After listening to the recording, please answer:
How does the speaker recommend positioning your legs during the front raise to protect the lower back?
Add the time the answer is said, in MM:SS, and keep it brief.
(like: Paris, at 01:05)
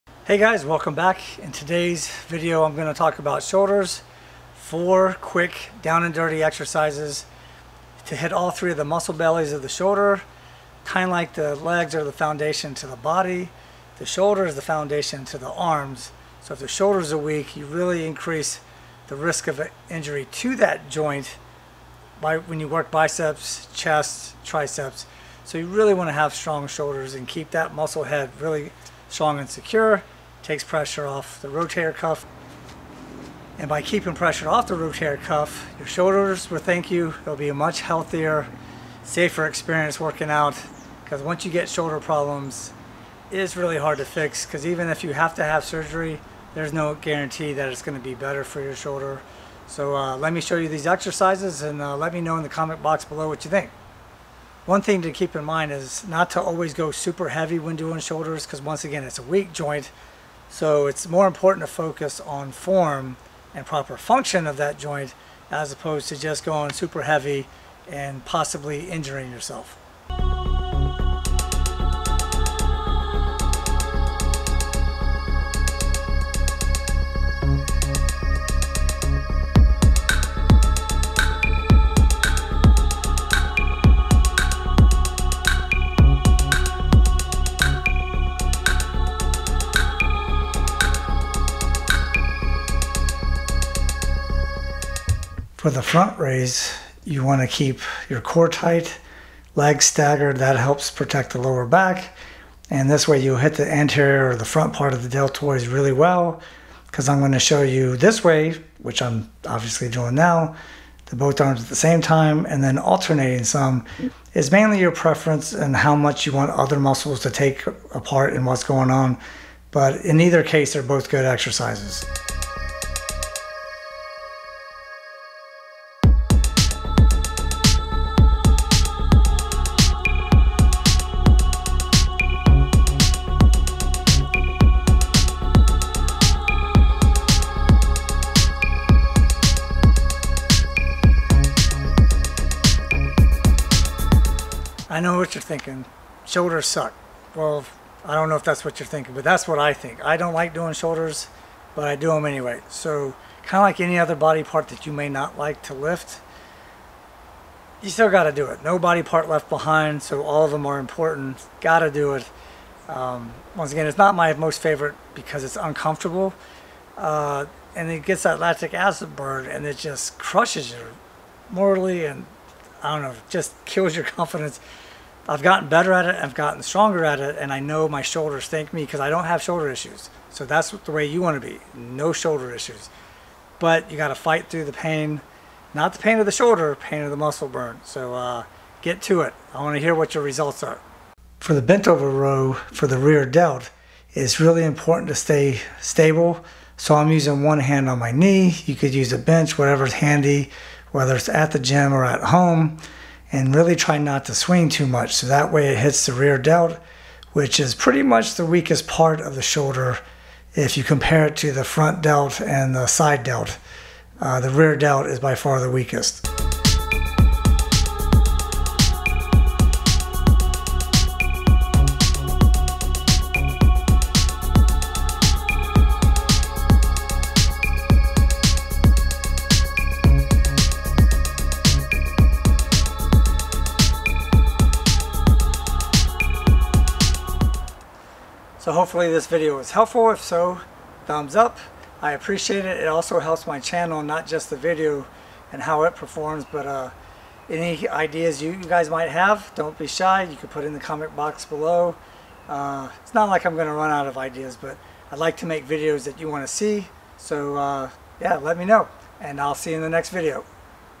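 staggered, at 01:39.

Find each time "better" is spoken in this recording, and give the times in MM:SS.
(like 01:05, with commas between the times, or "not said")
00:48, 02:55.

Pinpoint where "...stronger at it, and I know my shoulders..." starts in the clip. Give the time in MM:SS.
02:56.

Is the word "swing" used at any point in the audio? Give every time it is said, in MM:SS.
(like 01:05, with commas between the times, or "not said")
03:24.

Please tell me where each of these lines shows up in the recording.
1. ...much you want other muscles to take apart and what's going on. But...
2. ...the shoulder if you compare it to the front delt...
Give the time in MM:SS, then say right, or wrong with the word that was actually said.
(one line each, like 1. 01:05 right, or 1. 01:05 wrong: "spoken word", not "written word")
1. 01:55 right
2. 03:29 right.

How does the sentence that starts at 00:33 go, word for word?
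And by keeping pressure off the rotator cuff, your shoulders will thank you.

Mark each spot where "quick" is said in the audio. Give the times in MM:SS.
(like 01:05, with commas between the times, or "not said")
00:05.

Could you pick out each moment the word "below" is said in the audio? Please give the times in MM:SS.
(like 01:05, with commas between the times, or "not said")
00:53, 04:11.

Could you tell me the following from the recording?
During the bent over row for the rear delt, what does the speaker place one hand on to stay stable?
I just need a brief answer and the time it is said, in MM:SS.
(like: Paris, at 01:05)
my knee, at 03:17.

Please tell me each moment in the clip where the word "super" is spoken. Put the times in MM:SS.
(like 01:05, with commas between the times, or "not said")
00:56, 01:06.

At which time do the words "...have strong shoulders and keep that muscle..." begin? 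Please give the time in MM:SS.
00:26.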